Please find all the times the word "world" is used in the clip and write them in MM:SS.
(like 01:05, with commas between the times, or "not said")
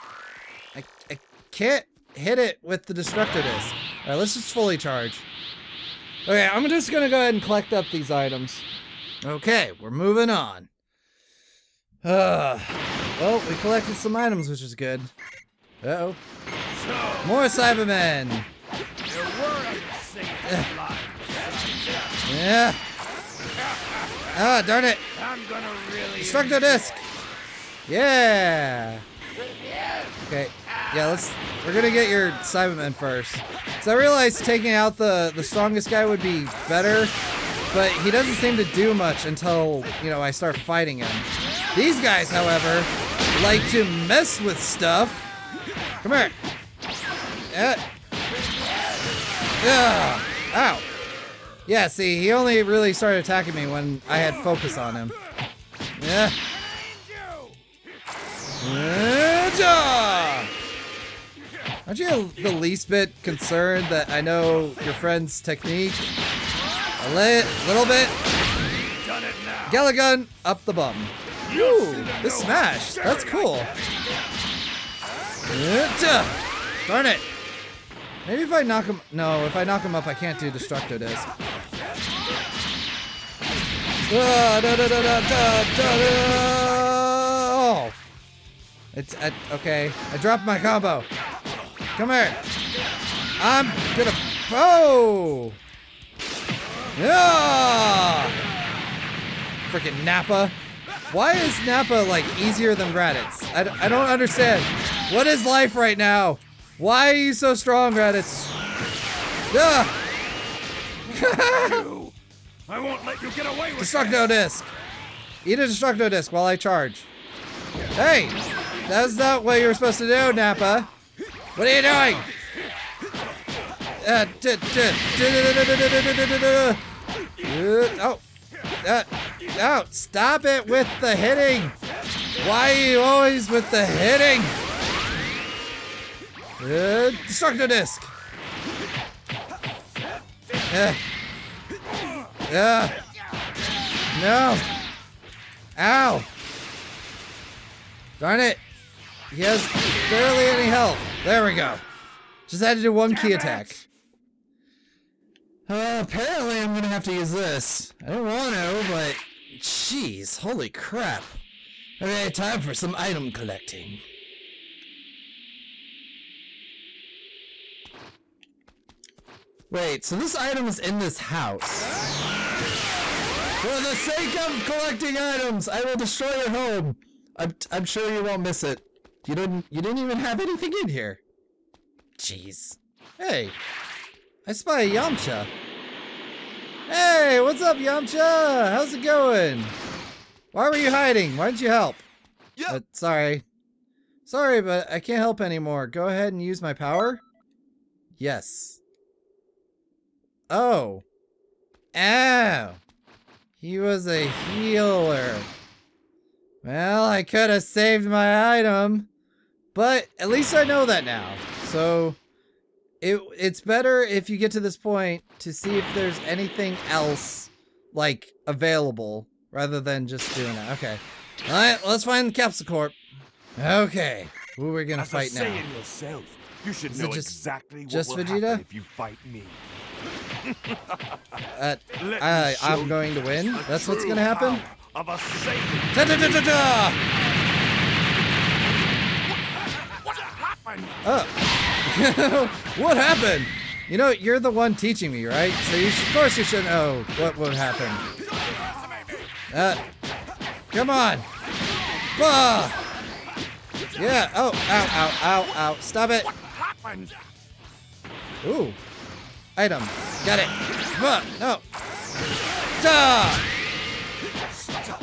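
not said.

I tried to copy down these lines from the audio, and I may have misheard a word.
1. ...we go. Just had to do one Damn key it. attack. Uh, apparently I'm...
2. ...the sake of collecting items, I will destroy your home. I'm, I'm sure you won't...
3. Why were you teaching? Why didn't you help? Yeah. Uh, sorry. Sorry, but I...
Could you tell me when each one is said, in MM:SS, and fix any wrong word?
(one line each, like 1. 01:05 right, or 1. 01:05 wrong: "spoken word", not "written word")
1. 02:31 right
2. 02:53 right
3. 03:10 wrong: "hiding", not "teaching".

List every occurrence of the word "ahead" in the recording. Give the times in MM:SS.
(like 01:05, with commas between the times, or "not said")
00:07, 03:16.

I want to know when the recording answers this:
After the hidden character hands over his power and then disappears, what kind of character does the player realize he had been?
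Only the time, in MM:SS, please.
03:24.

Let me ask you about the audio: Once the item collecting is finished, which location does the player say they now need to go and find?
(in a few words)
Capsule Corp.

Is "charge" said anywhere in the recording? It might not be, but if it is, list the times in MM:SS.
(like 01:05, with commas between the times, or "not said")
00:04, 01:56.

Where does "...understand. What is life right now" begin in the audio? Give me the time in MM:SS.
01:44.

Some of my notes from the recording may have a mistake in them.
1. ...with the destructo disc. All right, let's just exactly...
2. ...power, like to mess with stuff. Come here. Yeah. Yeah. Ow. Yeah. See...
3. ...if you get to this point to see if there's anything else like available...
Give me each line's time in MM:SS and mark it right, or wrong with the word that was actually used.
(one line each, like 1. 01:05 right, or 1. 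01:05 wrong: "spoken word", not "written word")
1. 00:02 wrong: "fully", not "exactly"
2. 00:42 wrong: "however", not "power"
3. 03:34 right.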